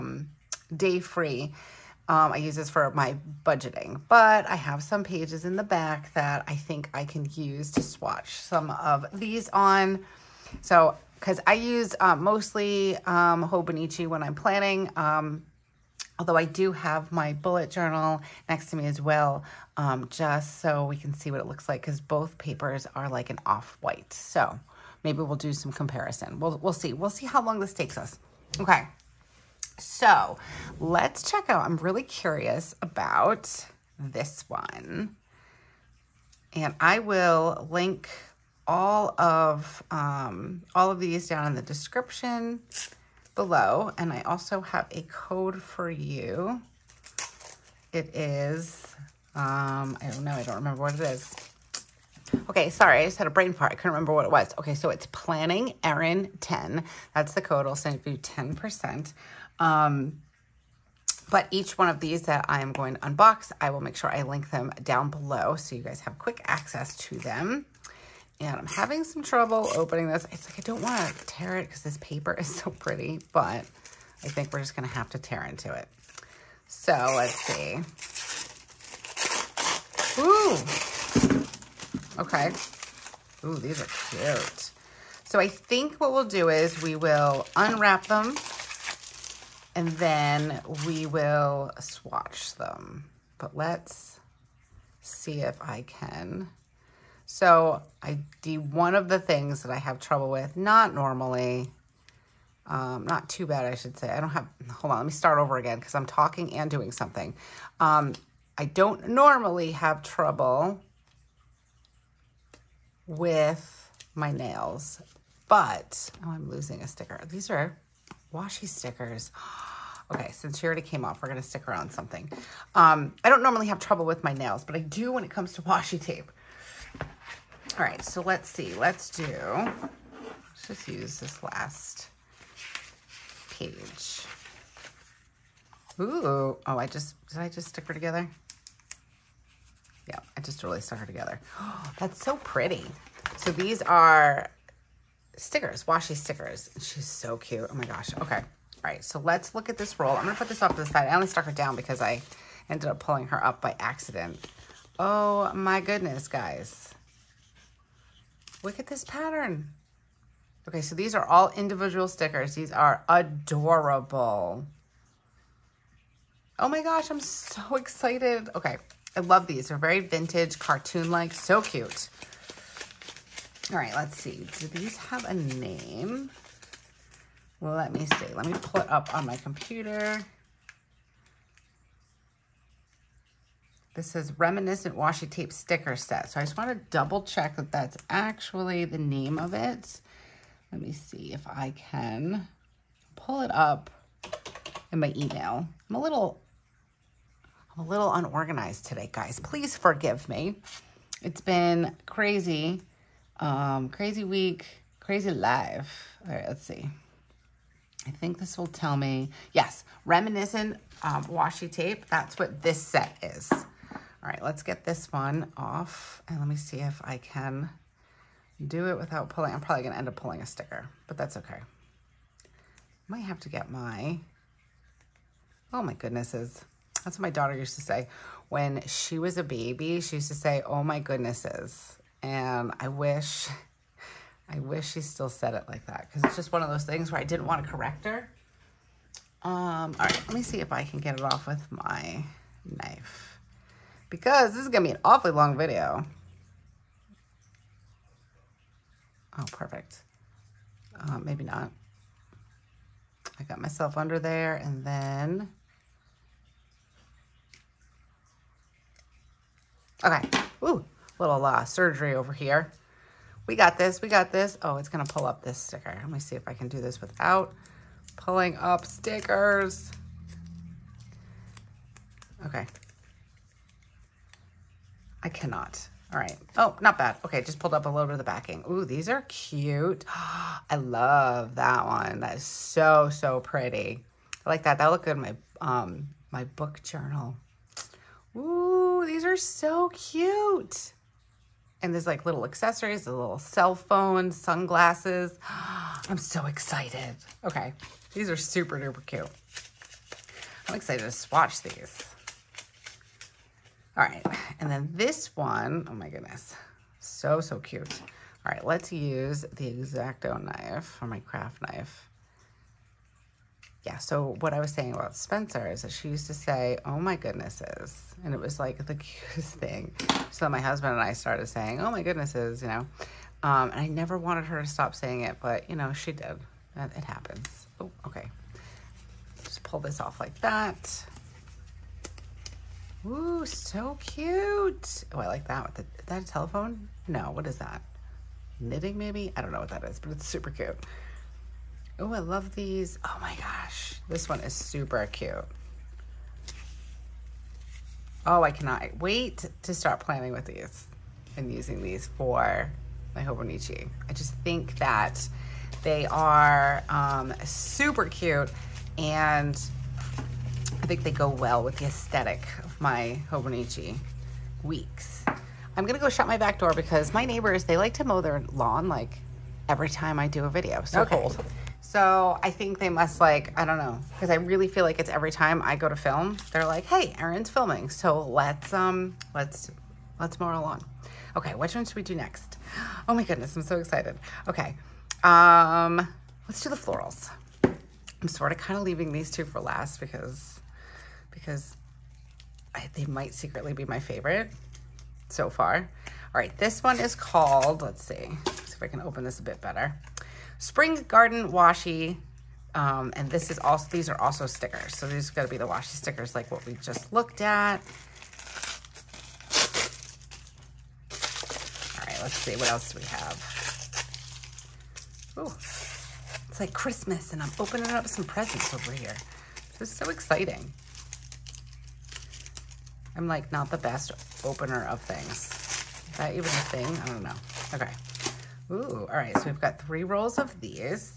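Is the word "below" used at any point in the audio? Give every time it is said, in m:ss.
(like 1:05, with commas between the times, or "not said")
0:43, 1:05.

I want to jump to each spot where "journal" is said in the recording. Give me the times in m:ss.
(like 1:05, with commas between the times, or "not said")
0:17, 4:46.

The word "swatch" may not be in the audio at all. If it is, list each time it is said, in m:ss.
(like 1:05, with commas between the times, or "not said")
0:07, 1:31, 5:01.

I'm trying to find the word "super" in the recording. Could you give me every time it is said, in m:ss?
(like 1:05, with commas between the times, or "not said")
4:58, 5:40, 5:44, 5:57.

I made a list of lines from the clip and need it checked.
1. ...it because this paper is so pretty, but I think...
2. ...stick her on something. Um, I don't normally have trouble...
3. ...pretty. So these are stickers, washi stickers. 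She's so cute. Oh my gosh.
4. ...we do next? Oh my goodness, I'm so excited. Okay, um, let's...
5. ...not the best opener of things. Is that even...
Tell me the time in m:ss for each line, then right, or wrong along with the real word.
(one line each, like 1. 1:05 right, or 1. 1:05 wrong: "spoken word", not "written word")
1. 1:11 right
2. 2:01 right
3. 2:22 right
4. 6:21 right
5. 7:03 right.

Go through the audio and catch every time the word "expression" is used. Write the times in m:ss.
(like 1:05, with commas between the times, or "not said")
not said.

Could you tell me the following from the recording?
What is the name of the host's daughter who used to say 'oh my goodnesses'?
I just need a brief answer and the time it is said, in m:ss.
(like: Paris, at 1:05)
Spencer, at 5:15.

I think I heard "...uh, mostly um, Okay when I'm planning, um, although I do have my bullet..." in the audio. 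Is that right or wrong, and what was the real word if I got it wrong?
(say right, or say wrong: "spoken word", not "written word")
wrong: "Hobonichi", not "Okay".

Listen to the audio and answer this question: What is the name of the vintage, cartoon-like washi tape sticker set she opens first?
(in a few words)
Reminiscent Washi Tape Sticker Set.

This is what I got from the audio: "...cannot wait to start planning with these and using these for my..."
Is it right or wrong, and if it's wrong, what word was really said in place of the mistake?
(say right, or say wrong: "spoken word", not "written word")
right.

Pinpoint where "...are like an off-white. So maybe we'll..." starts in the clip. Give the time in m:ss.
0:22.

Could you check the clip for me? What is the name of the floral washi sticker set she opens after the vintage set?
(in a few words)
Spring Garden Washi.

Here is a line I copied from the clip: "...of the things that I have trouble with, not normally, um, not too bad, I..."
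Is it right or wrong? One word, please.
right.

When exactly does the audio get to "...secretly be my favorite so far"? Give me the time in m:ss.
6:33.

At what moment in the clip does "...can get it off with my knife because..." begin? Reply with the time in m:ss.
4:00.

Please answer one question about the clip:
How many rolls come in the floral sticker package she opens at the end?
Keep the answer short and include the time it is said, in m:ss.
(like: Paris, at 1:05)
3, at 7:09.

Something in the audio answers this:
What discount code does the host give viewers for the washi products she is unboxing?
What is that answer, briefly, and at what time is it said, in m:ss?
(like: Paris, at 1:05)
Planning Erin 10, at 0:55.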